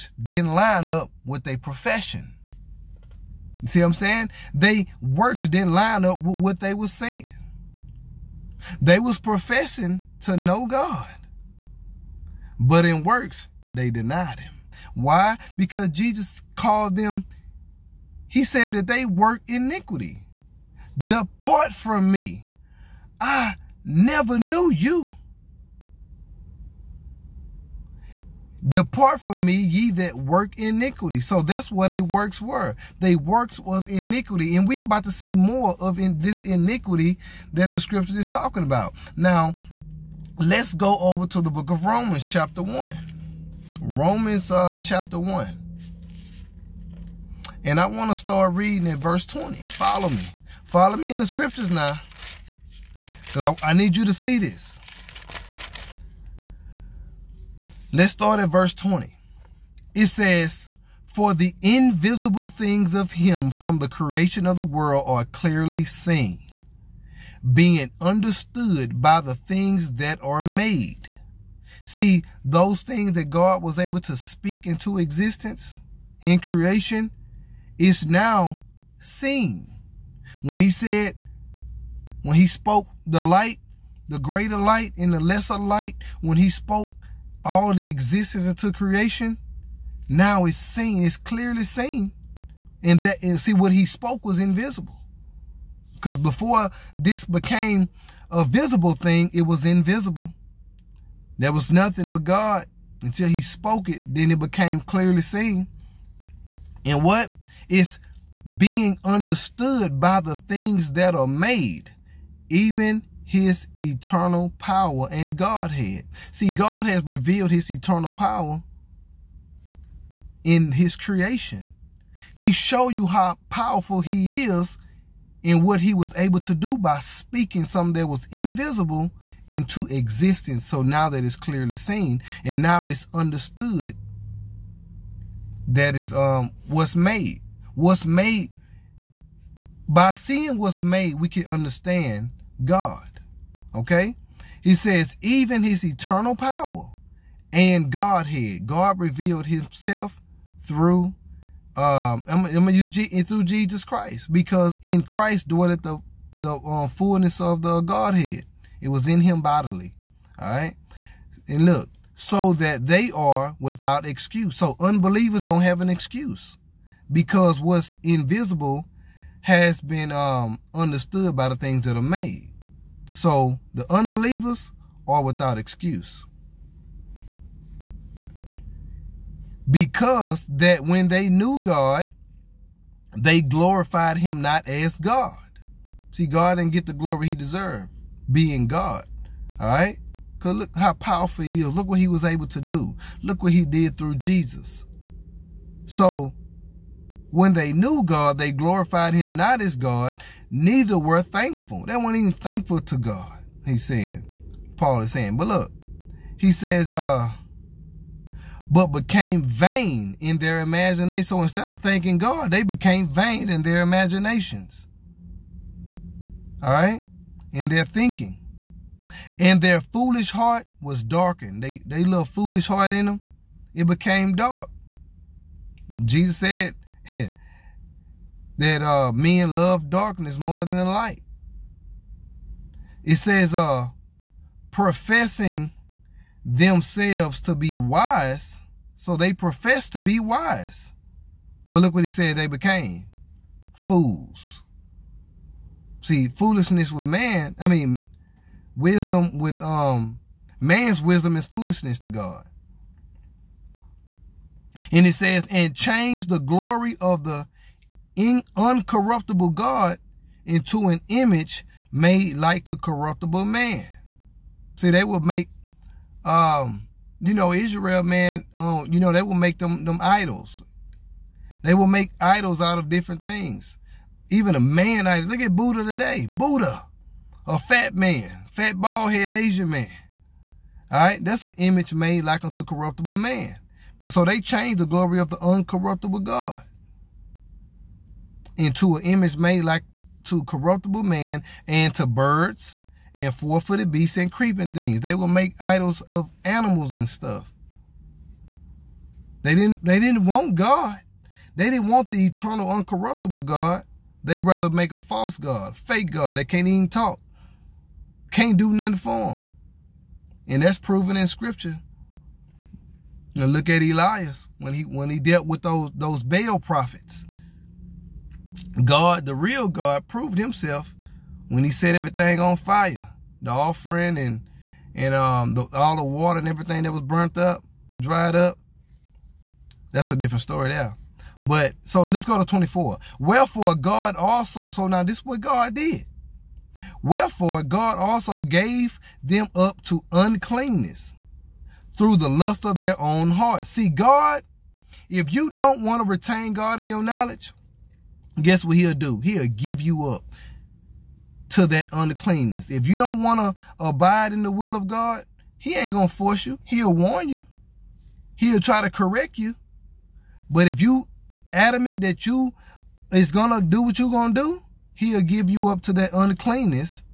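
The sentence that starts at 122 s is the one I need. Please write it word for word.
He showed you how powerful he is in what he was able to do by speaking something that was invisible into existence.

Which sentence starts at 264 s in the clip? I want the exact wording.
See, they would make, um, you know, Israel, man, um, you know, they will make them them idols.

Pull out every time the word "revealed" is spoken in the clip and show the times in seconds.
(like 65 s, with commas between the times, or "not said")
117 s, 148 s.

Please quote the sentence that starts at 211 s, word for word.
So instead of thanking God, they became vain in their imaginations.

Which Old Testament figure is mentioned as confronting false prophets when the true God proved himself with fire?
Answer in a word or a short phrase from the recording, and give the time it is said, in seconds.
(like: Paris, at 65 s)
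Elias, at 313 s.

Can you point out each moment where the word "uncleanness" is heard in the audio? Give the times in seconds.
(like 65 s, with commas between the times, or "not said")
340 s, 351 s, 366 s.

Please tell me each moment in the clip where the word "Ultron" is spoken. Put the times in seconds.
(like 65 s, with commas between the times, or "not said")
not said.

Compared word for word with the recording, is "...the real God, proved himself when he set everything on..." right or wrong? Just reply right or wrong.
right.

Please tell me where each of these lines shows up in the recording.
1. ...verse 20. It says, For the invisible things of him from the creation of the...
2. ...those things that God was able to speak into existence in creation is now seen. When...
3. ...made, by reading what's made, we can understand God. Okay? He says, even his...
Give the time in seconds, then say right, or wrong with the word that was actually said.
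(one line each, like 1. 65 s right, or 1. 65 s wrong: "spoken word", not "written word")
1. 58 s right
2. 72 s right
3. 138 s wrong: "seeing", not "reading".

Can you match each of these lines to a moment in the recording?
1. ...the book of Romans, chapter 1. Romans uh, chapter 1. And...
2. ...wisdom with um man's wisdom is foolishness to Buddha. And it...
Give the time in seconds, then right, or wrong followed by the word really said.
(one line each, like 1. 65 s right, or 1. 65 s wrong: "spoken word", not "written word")
1. 41 s right
2. 248 s wrong: "God", not "Buddha".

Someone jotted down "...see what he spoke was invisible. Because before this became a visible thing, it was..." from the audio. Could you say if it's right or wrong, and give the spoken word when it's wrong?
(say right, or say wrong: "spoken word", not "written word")
right.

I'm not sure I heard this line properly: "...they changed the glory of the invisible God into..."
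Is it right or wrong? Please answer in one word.
wrong.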